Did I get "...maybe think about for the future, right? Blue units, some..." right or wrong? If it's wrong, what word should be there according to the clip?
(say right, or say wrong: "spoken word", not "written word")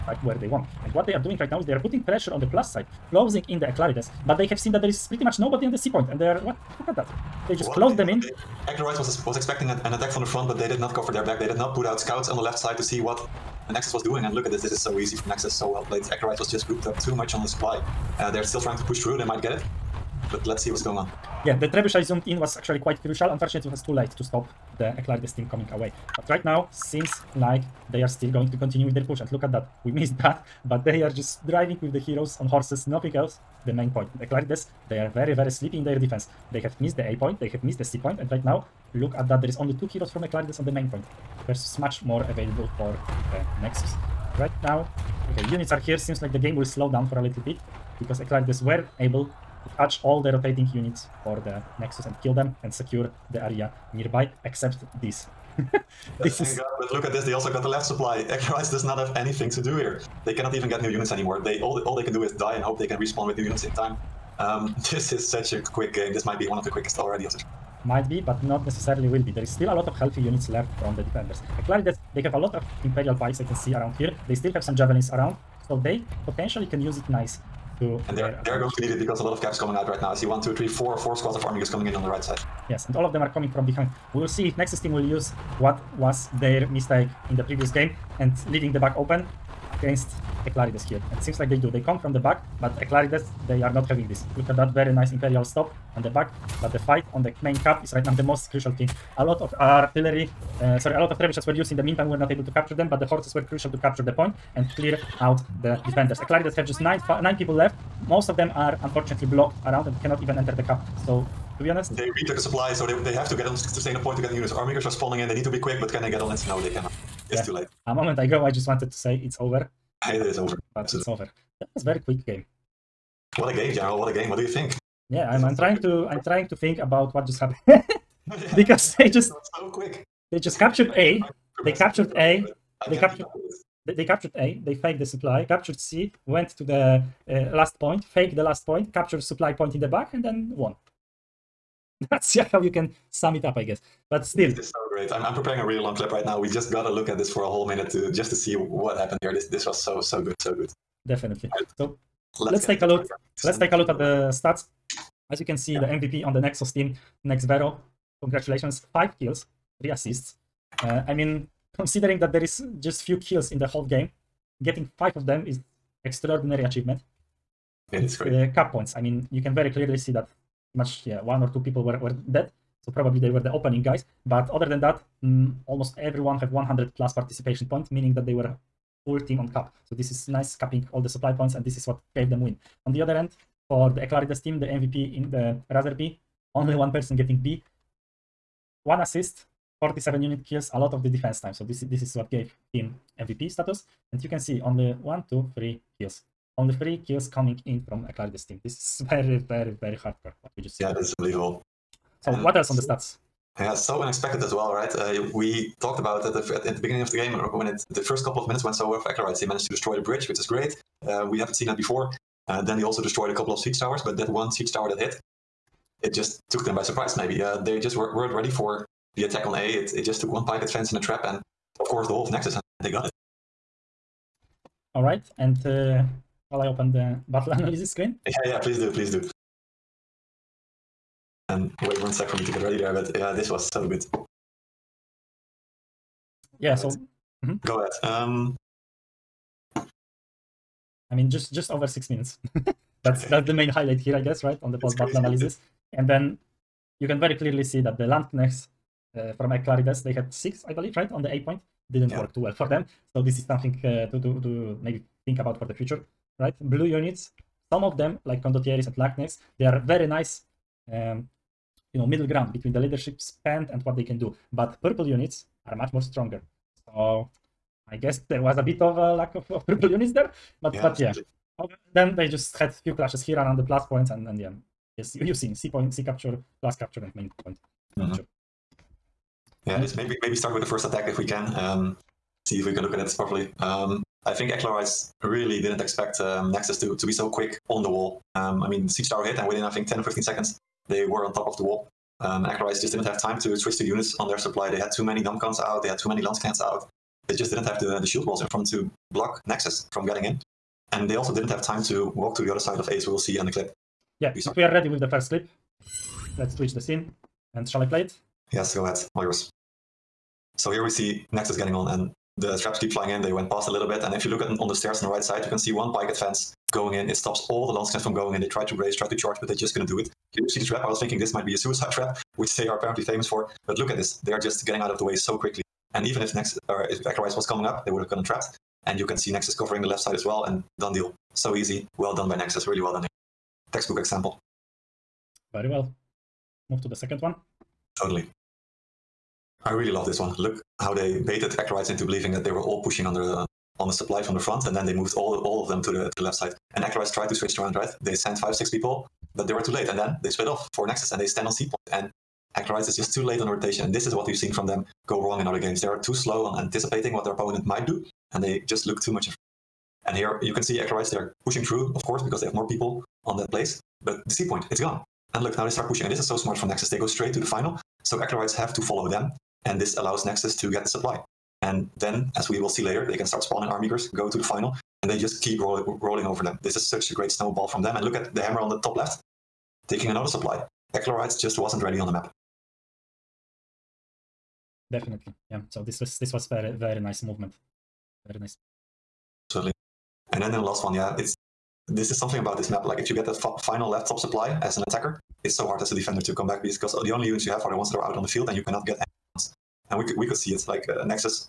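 right.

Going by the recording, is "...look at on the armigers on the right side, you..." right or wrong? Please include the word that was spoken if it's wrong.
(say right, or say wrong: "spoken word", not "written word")
wrong: "stairs", not "armigers".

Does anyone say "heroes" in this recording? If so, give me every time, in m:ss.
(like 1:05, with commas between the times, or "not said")
0:31, 0:39.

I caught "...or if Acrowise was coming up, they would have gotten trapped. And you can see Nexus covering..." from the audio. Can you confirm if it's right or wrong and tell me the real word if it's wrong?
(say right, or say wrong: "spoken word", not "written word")
right.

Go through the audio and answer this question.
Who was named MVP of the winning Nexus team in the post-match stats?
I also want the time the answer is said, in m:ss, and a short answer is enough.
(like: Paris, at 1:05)
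Nex Vero, at 2:37.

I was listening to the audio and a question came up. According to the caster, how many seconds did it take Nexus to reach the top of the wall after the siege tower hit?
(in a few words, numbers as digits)
10 or 15.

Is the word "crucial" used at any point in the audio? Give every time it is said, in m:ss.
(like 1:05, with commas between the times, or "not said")
0:23, 1:38, 1:43.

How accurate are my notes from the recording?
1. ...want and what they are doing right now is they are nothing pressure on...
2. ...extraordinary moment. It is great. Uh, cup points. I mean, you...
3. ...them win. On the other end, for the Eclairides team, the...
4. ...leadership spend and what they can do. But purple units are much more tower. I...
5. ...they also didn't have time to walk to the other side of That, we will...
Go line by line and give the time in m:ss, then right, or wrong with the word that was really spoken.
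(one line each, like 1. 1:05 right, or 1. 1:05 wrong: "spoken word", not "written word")
1. 0:00 wrong: "putting", not "nothing"
2. 2:46 wrong: "achievement", not "moment"
3. 3:02 right
4. 4:22 wrong: "stronger", not "tower"
5. 5:01 wrong: "Ace", not "That".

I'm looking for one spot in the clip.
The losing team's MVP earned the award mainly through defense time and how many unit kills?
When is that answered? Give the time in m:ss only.
3:09.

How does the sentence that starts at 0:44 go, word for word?
Right now, okay, units are here.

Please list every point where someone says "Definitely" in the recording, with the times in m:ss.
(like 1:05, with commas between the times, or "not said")
2:31, 6:24.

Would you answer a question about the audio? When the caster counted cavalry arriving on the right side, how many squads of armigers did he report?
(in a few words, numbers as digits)
4.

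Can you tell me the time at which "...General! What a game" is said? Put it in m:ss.
2:03.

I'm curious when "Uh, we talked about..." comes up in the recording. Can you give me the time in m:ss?
3:24.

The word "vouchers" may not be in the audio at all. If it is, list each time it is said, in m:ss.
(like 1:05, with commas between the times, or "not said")
not said.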